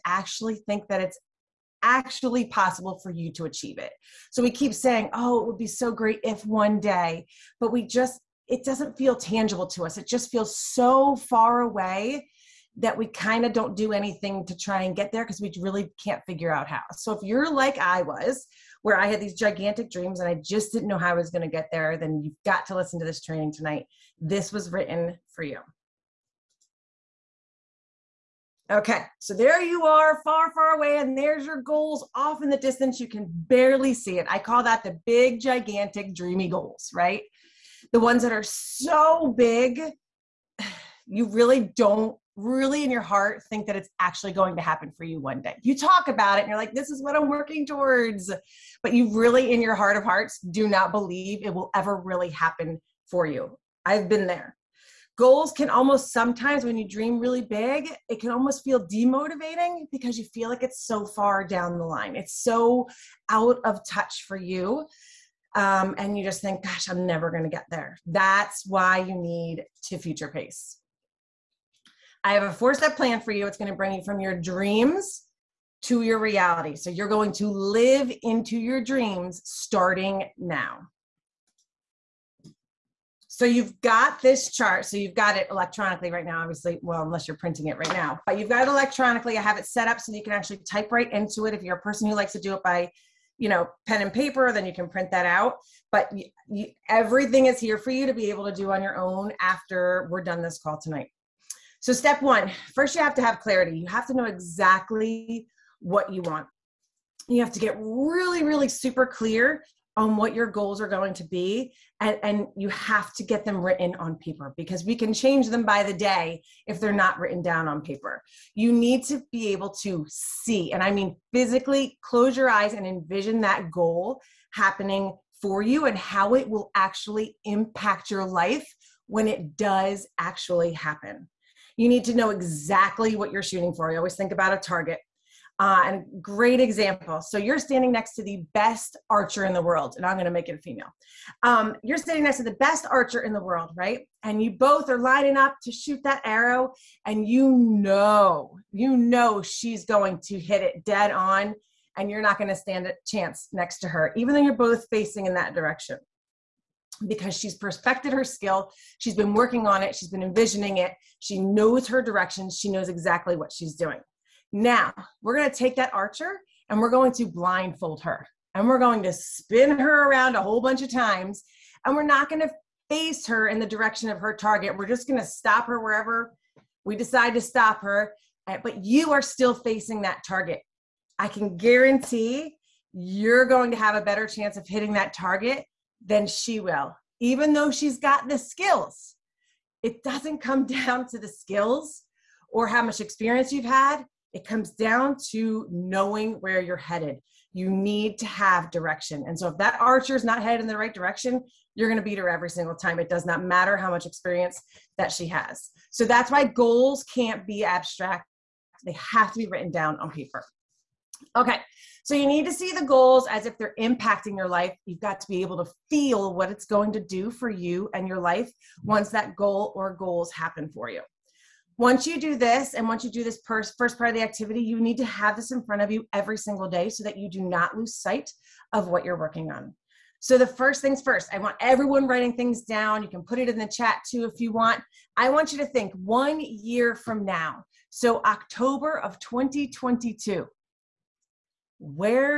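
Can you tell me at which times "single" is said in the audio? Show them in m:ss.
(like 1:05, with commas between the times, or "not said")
3:22, 3:46.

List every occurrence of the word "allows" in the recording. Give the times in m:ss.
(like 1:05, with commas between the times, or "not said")
not said.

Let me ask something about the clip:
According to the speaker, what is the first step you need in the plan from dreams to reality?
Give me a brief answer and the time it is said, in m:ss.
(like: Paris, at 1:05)
Clarity, at 1:43.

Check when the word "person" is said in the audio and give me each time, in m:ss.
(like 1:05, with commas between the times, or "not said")
1:31.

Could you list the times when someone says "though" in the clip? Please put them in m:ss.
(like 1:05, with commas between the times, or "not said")
2:34, 3:07.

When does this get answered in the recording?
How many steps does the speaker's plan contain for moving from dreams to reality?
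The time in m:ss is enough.
1:12.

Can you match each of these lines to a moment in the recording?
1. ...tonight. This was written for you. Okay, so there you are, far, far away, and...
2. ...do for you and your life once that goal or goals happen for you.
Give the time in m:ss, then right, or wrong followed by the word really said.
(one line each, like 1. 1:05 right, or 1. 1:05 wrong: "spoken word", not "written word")
1. 0:23 right
2. 3:37 right.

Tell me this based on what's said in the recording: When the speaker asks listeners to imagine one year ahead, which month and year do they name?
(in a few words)
October 2022.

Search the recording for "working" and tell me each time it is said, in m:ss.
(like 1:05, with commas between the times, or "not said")
0:47, 2:39, 3:49.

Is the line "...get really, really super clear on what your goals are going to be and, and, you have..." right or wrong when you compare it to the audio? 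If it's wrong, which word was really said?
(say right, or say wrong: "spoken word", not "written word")
right.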